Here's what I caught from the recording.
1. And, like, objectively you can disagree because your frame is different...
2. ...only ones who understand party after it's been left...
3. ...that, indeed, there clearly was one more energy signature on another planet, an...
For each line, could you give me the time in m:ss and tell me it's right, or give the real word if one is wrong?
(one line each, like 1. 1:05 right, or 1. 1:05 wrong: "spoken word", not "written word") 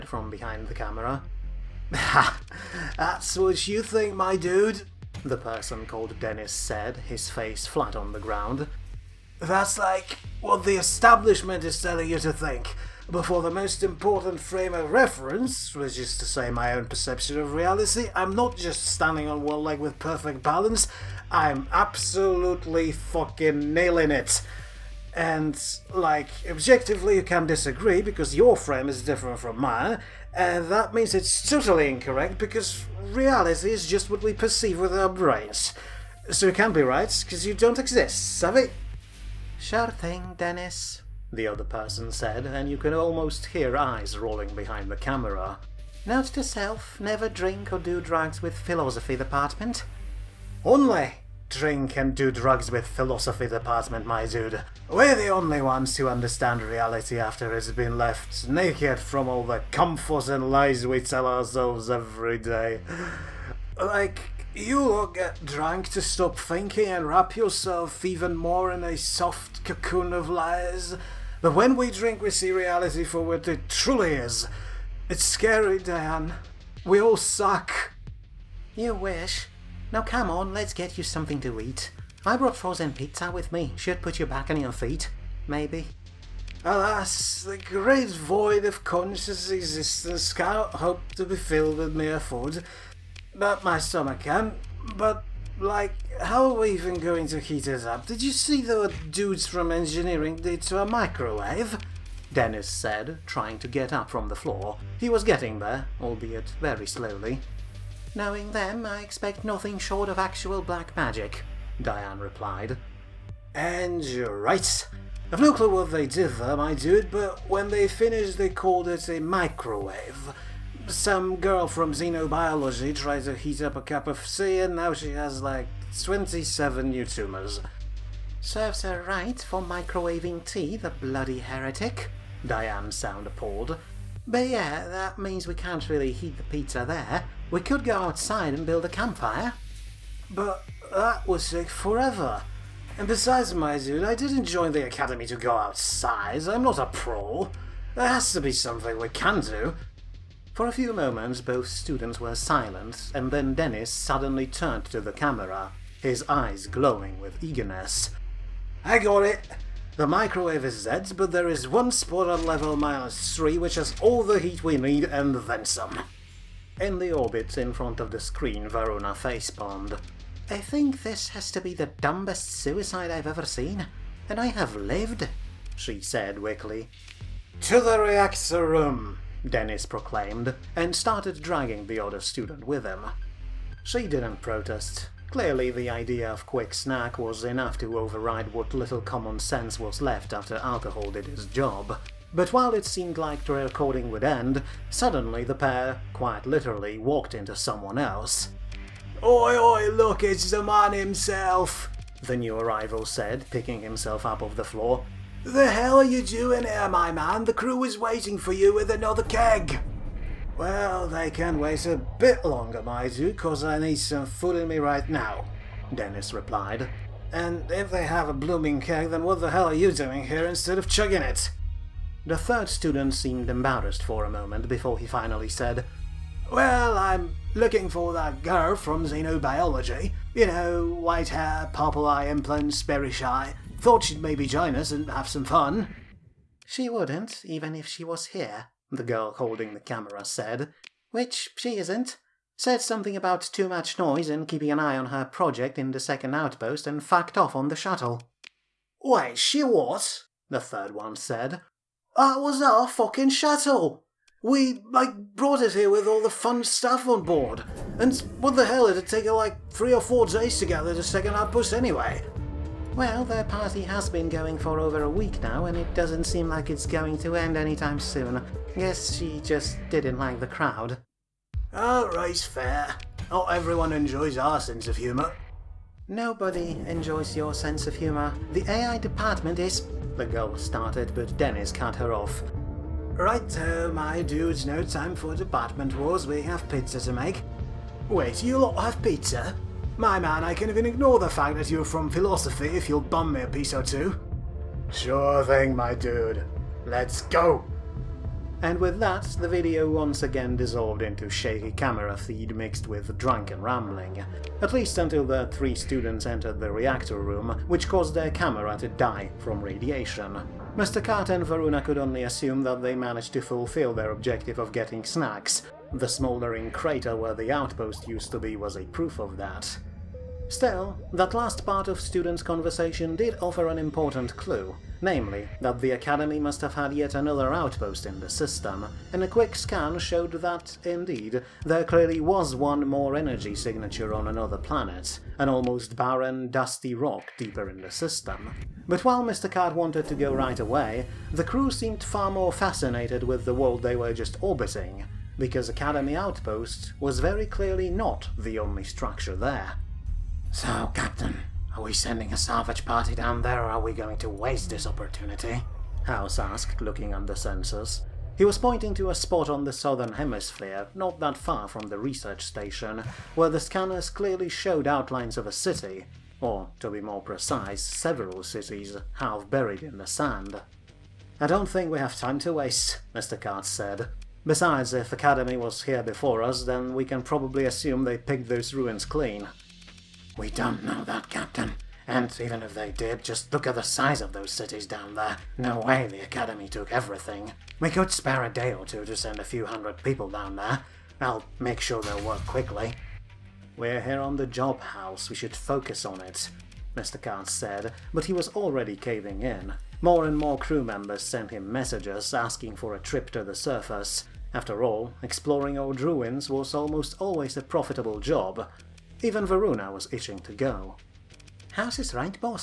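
1. 0:25 right
2. 0:55 wrong: "reality", not "party"
3. 5:30 right.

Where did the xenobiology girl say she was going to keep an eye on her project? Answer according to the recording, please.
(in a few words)
The second outpost.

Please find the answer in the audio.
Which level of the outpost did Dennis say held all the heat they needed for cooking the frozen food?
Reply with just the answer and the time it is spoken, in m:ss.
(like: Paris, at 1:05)
Level minus 3, at 2:42.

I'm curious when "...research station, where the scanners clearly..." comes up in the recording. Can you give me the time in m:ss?
6:01.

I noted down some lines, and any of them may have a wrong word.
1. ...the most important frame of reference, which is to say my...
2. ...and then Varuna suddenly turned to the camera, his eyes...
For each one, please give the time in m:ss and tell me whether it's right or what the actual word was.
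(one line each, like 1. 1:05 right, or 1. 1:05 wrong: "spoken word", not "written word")
1. 0:13 right
2. 2:33 wrong: "Dennis", not "Varuna".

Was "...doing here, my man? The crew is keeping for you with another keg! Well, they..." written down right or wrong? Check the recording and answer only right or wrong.
wrong.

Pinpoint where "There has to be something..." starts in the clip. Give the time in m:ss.
2:27.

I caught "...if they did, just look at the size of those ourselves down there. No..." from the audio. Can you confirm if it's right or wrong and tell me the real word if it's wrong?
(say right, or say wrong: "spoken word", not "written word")
wrong: "cities", not "ourselves".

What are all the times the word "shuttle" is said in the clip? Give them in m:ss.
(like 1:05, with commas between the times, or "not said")
4:07, 4:13.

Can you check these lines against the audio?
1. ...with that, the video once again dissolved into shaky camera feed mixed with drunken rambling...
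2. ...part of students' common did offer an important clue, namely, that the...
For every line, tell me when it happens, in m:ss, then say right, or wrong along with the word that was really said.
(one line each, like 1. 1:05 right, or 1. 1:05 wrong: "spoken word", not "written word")
1. 4:58 right
2. 5:21 wrong: "conversation", not "common".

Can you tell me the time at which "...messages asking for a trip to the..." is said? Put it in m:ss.
6:41.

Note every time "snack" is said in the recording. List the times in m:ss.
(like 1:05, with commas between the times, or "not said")
3:06, 5:15.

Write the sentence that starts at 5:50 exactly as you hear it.
So, Captain, are we sending a salvage party down there or are we going to waste this opportunity?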